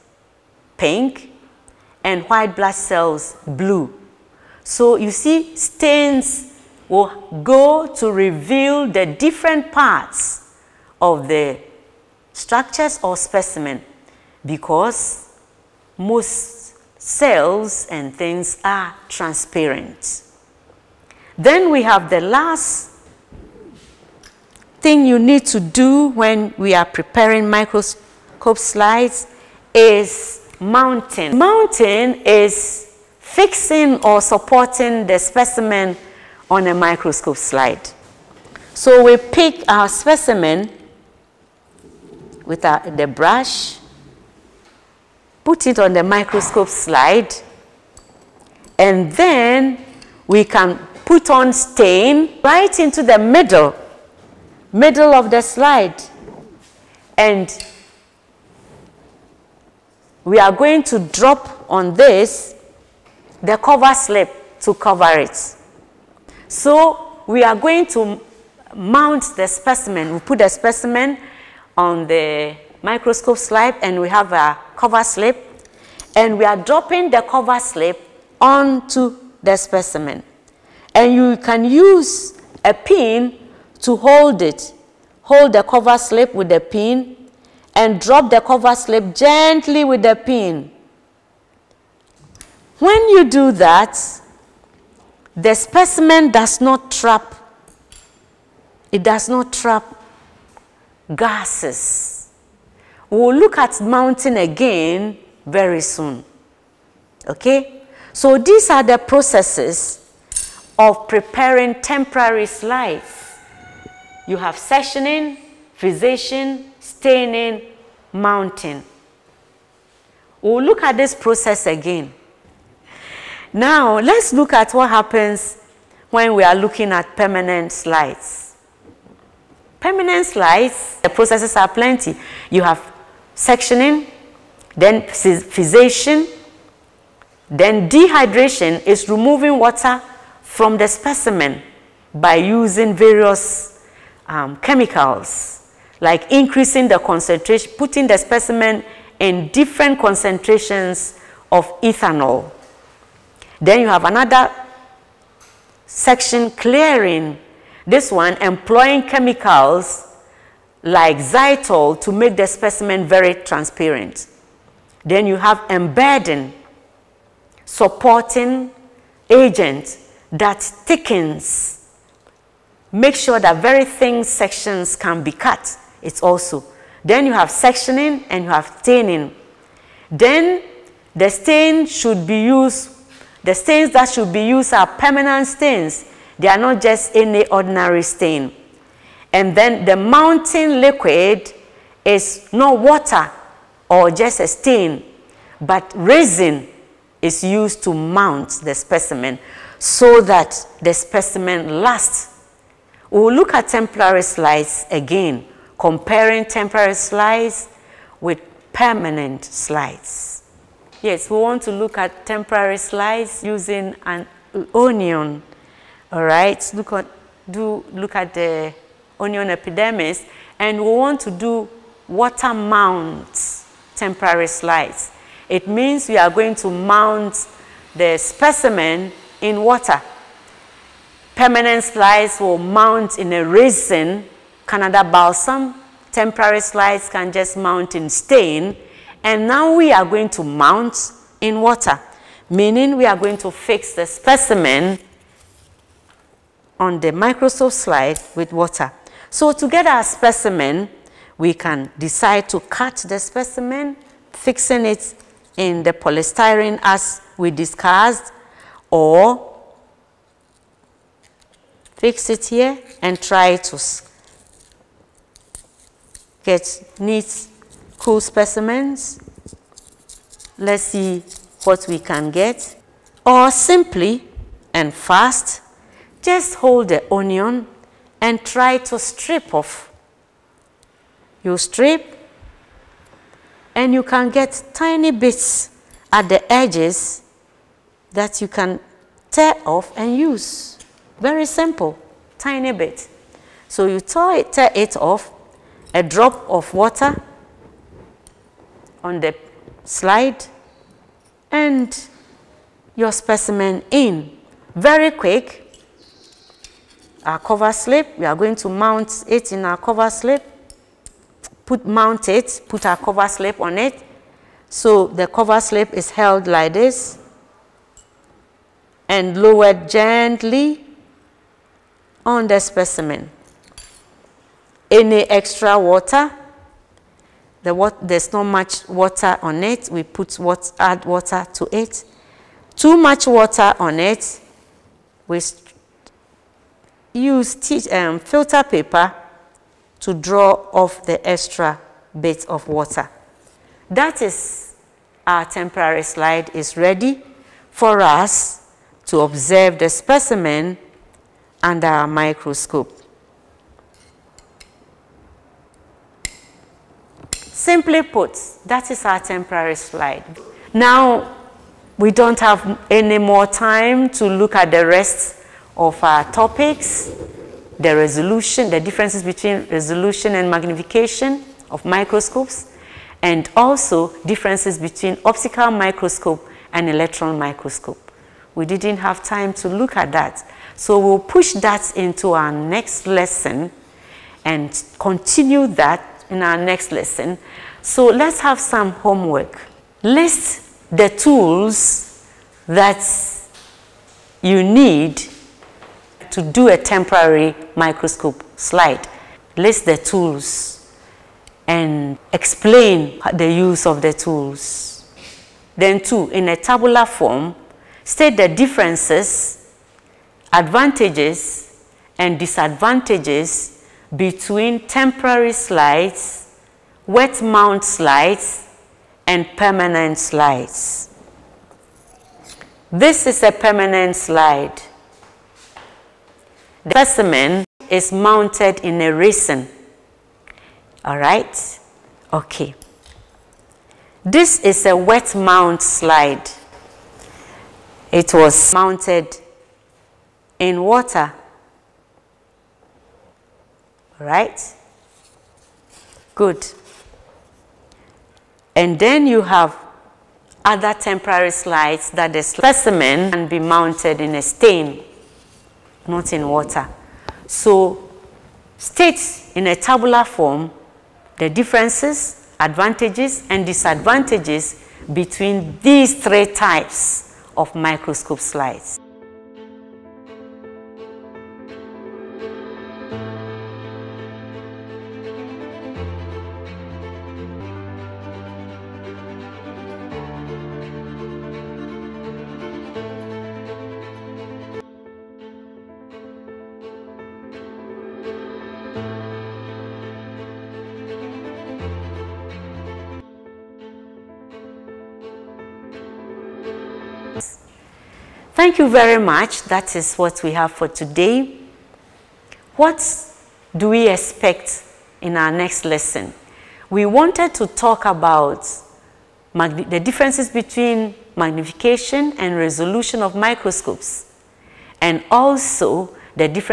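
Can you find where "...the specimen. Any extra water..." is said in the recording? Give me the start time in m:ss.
5:22.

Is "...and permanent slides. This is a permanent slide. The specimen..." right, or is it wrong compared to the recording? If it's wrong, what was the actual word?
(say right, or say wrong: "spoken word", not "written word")
right.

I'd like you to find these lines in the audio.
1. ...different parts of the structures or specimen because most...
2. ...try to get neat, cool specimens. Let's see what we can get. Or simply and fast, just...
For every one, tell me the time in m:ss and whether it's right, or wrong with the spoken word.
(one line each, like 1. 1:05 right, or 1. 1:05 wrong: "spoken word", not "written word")
1. 0:09 right
2. 4:23 right.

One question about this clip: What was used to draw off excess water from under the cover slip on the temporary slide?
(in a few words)
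Filter paper.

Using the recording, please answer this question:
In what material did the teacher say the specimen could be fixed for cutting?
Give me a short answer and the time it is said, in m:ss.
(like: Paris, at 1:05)
Polystyrene, at 4:15.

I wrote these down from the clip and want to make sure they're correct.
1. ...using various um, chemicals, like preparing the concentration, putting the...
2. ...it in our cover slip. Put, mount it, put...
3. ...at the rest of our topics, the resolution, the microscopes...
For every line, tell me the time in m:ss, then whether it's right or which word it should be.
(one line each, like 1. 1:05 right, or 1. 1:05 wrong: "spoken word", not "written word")
1. 2:22 wrong: "increasing", not "preparing"
2. 5:09 right
3. 6:04 wrong: "differences", not "microscopes".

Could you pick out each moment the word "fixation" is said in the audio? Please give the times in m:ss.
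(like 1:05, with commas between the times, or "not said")
1:55, 2:15.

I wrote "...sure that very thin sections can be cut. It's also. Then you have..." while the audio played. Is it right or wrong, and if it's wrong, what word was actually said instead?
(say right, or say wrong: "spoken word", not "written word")
right.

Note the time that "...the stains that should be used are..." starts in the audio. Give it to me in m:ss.
3:03.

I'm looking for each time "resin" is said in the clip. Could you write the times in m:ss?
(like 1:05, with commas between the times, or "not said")
3:15, 3:53, 7:09.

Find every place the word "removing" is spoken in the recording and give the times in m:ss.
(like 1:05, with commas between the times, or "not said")
2:19.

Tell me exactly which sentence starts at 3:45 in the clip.
It means we are going to mount the specimen in water.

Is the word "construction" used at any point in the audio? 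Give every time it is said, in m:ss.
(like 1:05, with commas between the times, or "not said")
not said.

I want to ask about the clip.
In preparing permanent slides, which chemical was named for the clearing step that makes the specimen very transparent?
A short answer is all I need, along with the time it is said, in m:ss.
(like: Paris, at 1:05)
Xylol, at 2:41.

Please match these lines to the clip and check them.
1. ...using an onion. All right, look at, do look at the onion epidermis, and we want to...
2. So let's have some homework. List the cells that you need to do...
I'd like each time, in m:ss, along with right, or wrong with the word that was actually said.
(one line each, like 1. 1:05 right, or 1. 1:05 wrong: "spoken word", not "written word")
1. 3:33 right
2. 6:27 wrong: "tools", not "cells".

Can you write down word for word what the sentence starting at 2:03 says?
Now, let's look at what happens when we are looking at permanent slides.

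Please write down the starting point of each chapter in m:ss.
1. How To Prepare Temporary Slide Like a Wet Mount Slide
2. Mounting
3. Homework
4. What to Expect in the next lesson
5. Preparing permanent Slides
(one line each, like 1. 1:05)
1. 3:33
2. 0:29
3. 6:28
4. 8:22
5. 2:06.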